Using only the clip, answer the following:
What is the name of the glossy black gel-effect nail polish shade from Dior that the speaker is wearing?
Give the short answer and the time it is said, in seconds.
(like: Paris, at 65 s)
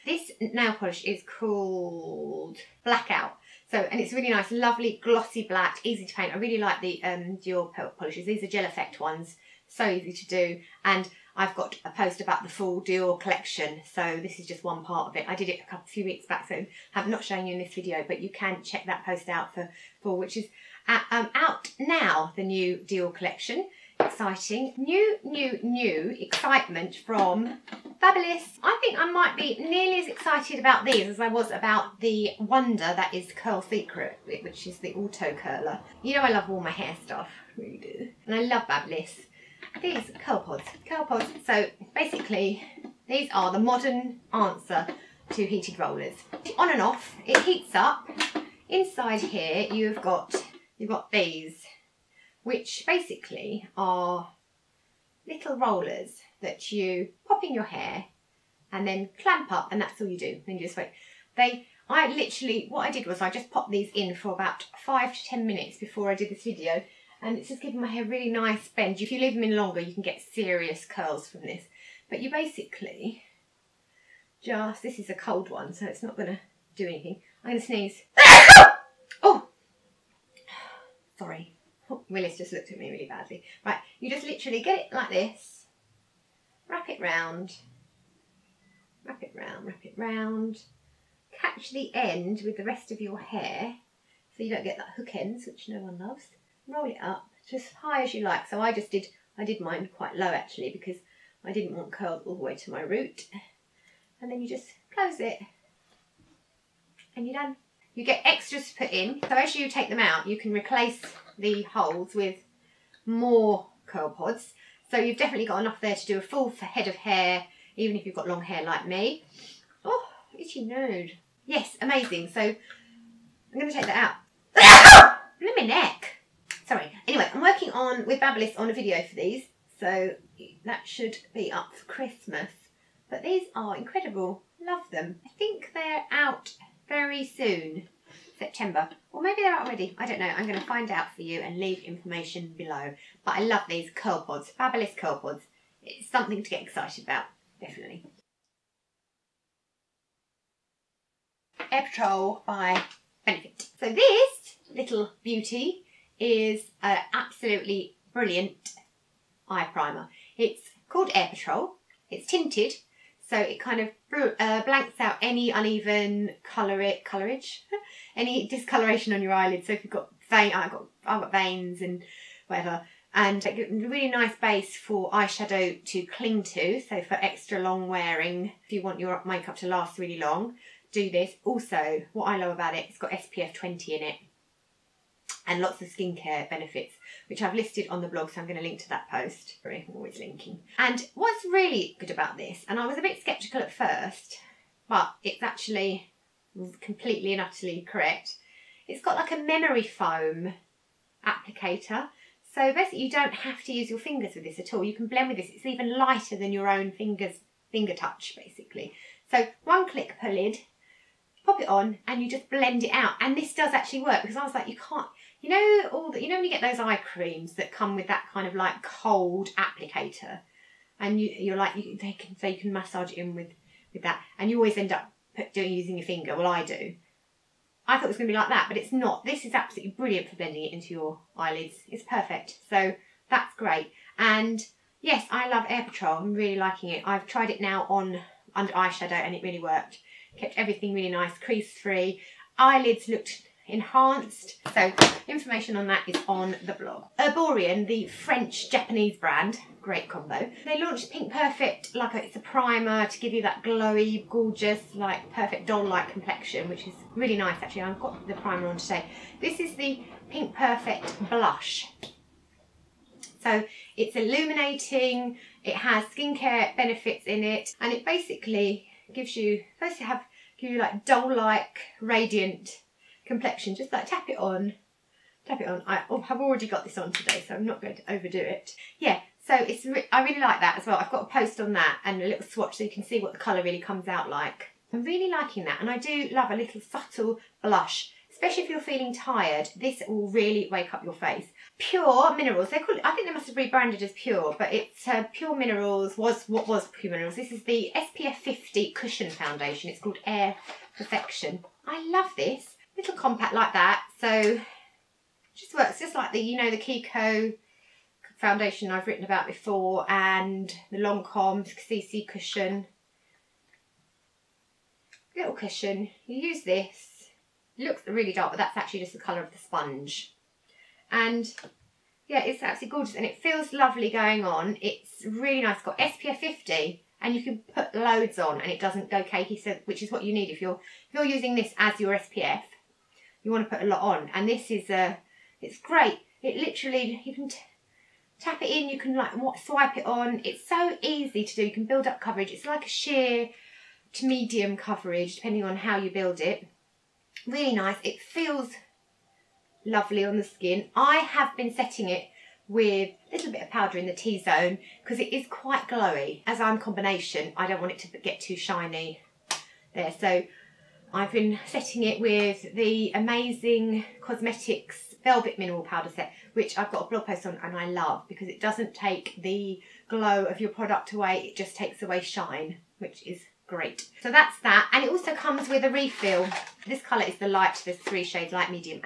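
Blackout, at 2 s.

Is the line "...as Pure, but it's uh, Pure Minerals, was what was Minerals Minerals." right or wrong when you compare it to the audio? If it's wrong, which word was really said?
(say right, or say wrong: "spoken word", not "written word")
wrong: "Pure", not "Minerals".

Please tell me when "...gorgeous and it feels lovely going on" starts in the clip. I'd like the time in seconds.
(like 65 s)
322 s.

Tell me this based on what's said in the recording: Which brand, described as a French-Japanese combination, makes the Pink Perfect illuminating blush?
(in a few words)
Erborian.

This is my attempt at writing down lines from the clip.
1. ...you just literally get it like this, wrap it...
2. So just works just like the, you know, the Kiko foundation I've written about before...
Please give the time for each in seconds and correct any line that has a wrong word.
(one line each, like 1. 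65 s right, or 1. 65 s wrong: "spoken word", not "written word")
1. 83 s right
2. 304 s right.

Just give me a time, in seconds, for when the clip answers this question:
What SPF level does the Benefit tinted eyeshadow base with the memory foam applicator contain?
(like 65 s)
183 s.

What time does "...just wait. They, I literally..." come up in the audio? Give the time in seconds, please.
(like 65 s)
60 s.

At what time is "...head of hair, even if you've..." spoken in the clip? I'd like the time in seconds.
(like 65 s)
116 s.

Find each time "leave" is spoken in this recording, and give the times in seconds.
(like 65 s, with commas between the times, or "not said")
69 s, 141 s.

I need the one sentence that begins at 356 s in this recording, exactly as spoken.
As I'm combination, I don't want it to get too shiny there.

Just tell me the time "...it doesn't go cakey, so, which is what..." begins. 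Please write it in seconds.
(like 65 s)
328 s.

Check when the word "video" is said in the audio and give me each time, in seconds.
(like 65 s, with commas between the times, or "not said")
17 s, 66 s, 128 s.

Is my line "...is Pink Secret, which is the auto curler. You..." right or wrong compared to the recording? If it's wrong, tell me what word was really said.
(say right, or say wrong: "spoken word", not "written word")
wrong: "Curl", not "Pink".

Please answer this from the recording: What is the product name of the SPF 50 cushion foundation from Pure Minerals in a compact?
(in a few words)
Air Perfection.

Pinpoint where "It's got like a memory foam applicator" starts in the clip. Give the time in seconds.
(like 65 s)
198 s.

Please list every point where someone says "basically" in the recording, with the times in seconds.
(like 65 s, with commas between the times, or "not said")
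41 s, 52 s, 72 s, 202 s, 208 s, 268 s.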